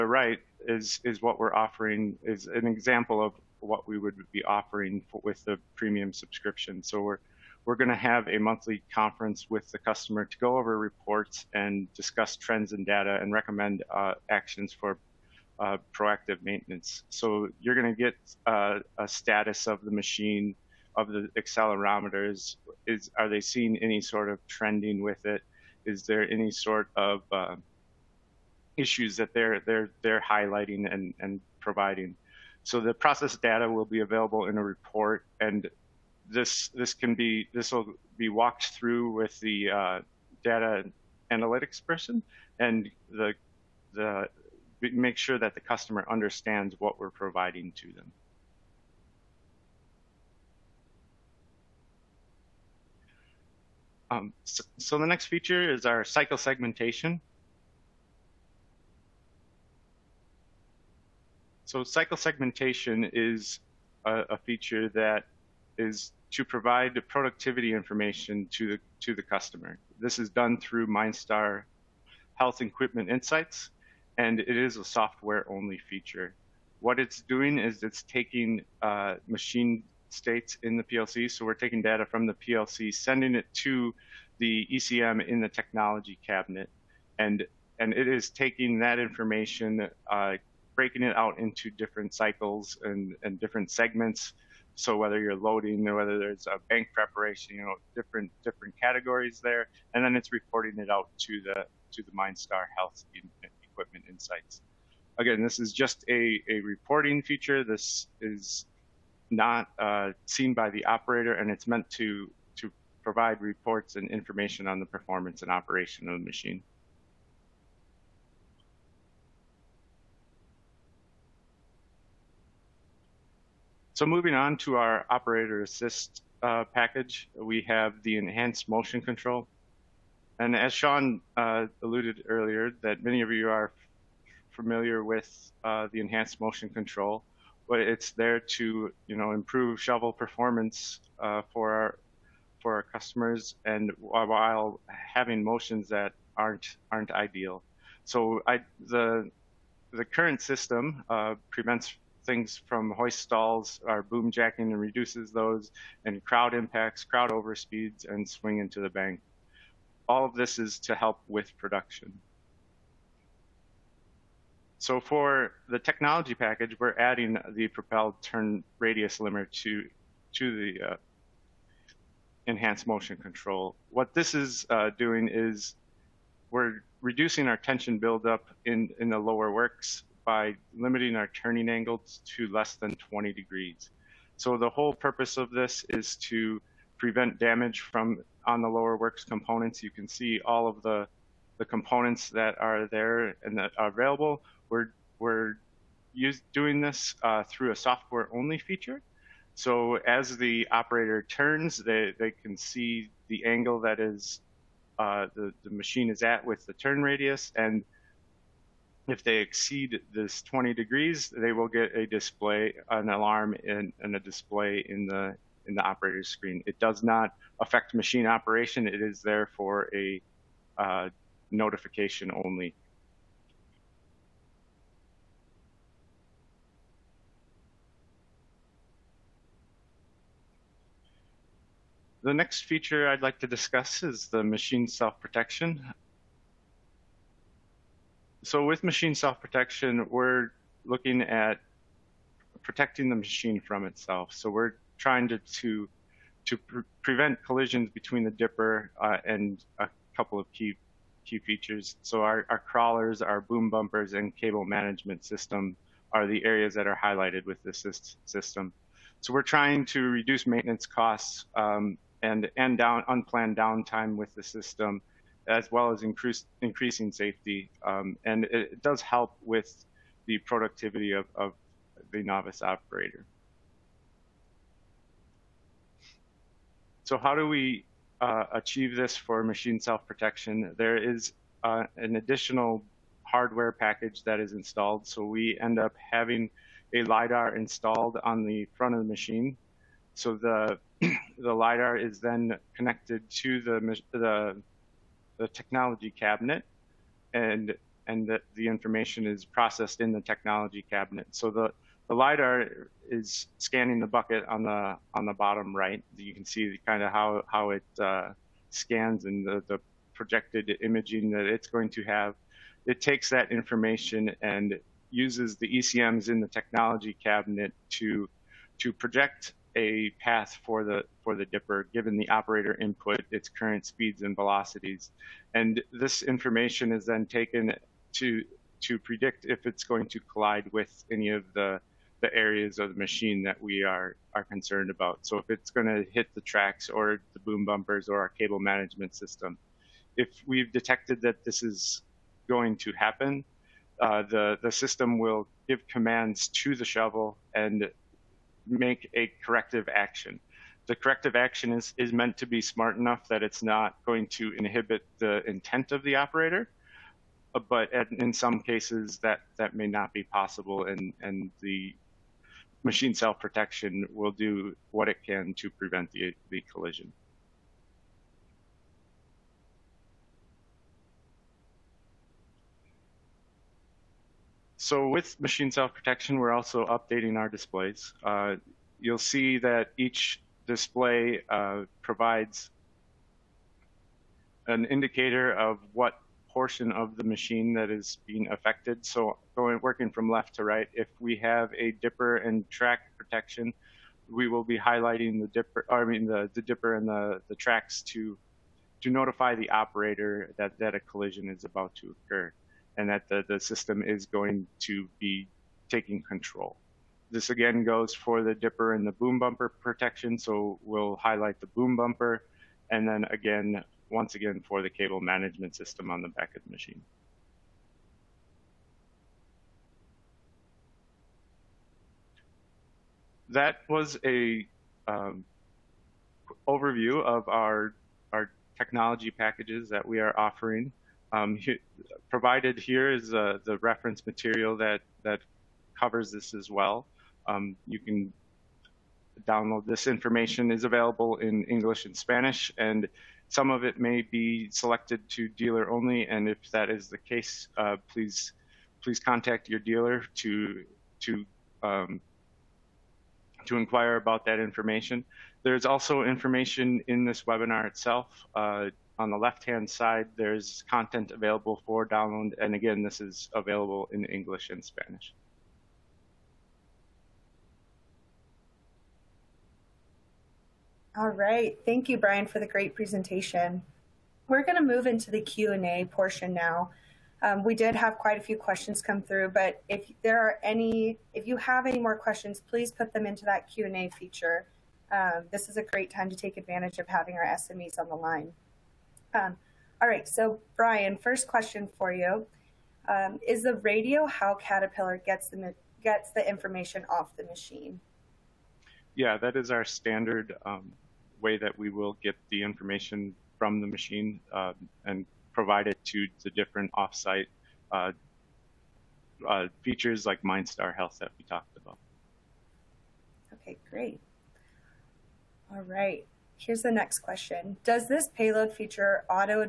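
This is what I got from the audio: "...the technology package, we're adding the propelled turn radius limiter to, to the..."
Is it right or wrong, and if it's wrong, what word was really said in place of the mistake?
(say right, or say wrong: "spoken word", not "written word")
right.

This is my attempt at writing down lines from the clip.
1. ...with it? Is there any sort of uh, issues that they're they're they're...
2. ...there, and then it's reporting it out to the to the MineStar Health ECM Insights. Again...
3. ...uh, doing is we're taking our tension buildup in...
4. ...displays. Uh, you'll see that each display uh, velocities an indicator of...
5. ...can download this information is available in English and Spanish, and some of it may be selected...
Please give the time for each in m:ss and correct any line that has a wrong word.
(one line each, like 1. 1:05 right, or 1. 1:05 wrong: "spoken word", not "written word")
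1. 0:25 right
2. 1:39 wrong: "Equipment", not "ECM"
3. 2:54 wrong: "reducing", not "taking"
4. 6:17 wrong: "provides", not "velocities"
5. 7:17 right.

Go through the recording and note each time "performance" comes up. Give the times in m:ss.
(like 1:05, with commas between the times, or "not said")
1:54, 2:20.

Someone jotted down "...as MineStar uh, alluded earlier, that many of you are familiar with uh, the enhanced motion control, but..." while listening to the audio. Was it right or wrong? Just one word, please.
wrong.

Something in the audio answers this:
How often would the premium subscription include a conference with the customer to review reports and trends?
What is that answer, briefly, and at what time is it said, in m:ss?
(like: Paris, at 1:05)
Monthly, at 0:08.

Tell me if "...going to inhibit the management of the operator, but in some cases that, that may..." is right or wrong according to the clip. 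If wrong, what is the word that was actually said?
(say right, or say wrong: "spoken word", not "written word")
wrong: "intent", not "management".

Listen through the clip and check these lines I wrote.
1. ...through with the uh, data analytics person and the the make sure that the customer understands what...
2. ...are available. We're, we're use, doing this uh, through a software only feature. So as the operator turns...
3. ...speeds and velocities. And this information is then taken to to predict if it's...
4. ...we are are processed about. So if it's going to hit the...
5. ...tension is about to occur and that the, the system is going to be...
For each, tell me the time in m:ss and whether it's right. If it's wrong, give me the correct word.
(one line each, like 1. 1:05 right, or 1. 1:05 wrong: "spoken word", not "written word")
1. 0:38 right
2. 3:13 right
3. 5:23 right
4. 5:33 wrong: "concerned", not "processed"
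5. 6:41 wrong: "collision", not "tension".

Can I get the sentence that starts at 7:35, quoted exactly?
There's also information in this webinar itself.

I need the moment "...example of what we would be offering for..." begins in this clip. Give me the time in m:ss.
0:02.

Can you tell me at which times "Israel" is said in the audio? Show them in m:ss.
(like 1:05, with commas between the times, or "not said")
not said.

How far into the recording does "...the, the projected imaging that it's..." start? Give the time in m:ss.
5:09.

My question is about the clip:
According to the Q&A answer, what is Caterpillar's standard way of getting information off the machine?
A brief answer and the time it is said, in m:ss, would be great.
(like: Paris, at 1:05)
The radio, at 8:13.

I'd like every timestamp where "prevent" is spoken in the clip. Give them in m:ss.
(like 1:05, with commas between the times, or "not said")
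2:31, 3:06, 4:07, 6:05.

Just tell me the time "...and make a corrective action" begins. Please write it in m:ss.
5:47.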